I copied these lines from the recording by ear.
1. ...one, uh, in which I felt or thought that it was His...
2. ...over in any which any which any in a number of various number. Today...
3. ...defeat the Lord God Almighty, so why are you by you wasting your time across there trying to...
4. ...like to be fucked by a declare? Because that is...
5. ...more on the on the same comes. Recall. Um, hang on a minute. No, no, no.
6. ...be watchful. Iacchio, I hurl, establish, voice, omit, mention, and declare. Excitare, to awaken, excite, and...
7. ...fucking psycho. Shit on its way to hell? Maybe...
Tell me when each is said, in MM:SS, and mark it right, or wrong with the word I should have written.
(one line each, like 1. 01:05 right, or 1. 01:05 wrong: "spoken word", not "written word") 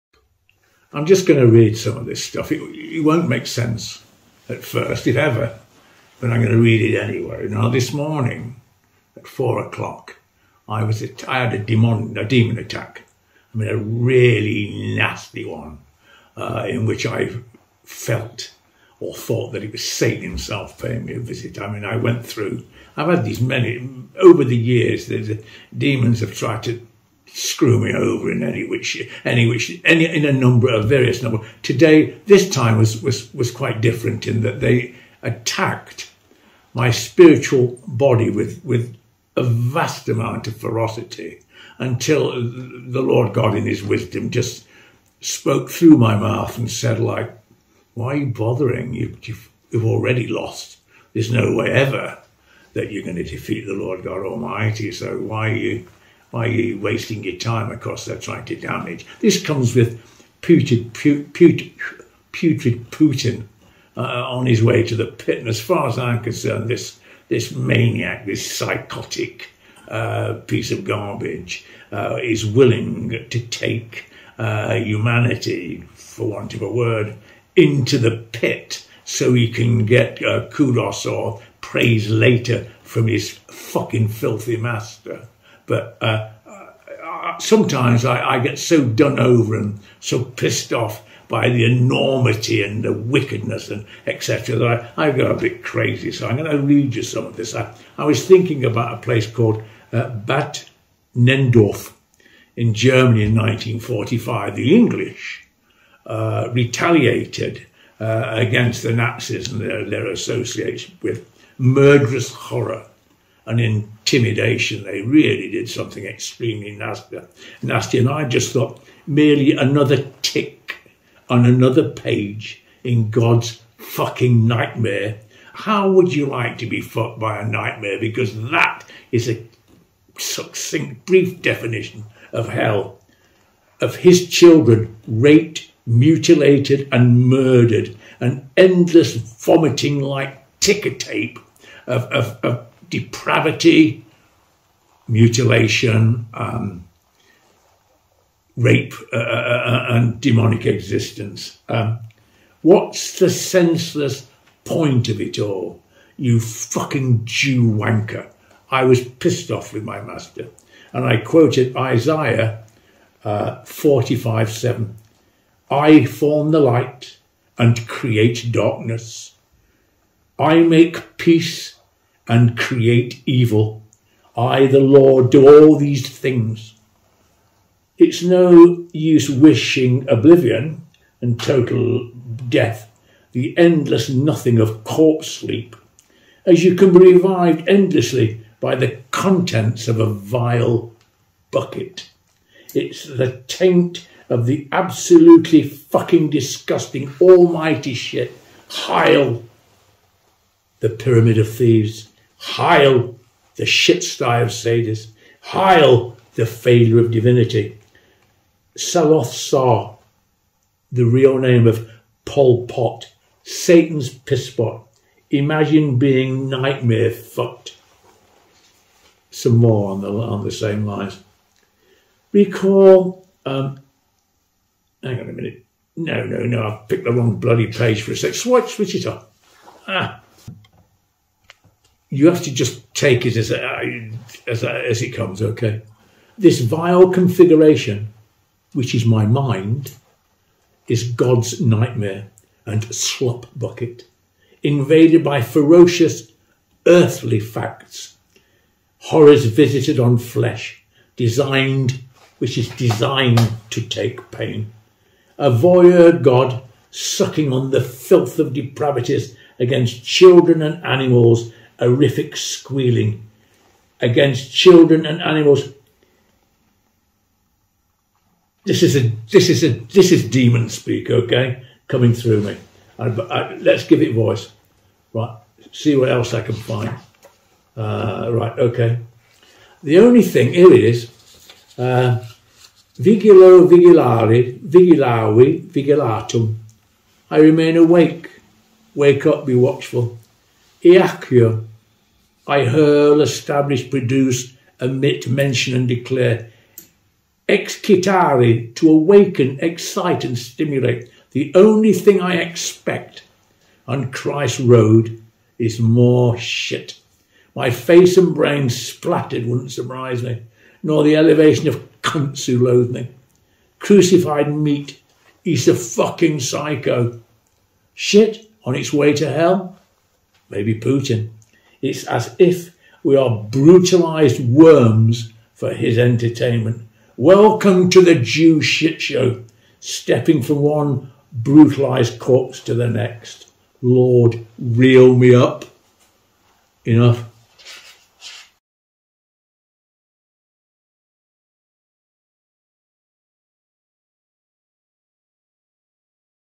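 1. 00:15 wrong: "Satan", not "His"
2. 00:27 right
3. 00:53 right
4. 02:06 wrong: "nightmare", not "declare"
5. 03:39 wrong: "lines", not "comes"
6. 04:49 wrong: "produce", not "voice"
7. 05:15 right.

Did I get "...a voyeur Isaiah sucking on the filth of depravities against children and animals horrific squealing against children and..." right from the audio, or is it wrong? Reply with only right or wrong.
wrong.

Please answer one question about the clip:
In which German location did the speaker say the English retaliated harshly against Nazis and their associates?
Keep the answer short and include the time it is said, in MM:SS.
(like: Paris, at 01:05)
Bad Nenndorf, at 01:40.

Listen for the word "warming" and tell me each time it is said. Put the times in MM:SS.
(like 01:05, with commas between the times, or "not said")
not said.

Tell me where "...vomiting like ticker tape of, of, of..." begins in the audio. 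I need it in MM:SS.
02:19.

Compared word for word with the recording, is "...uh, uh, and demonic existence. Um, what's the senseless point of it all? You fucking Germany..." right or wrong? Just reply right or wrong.
wrong.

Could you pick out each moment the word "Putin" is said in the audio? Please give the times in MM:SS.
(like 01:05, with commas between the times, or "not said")
01:02, 05:20.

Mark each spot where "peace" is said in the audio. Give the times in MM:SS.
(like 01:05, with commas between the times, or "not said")
02:51.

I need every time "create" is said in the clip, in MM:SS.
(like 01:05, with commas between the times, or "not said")
02:47, 02:52.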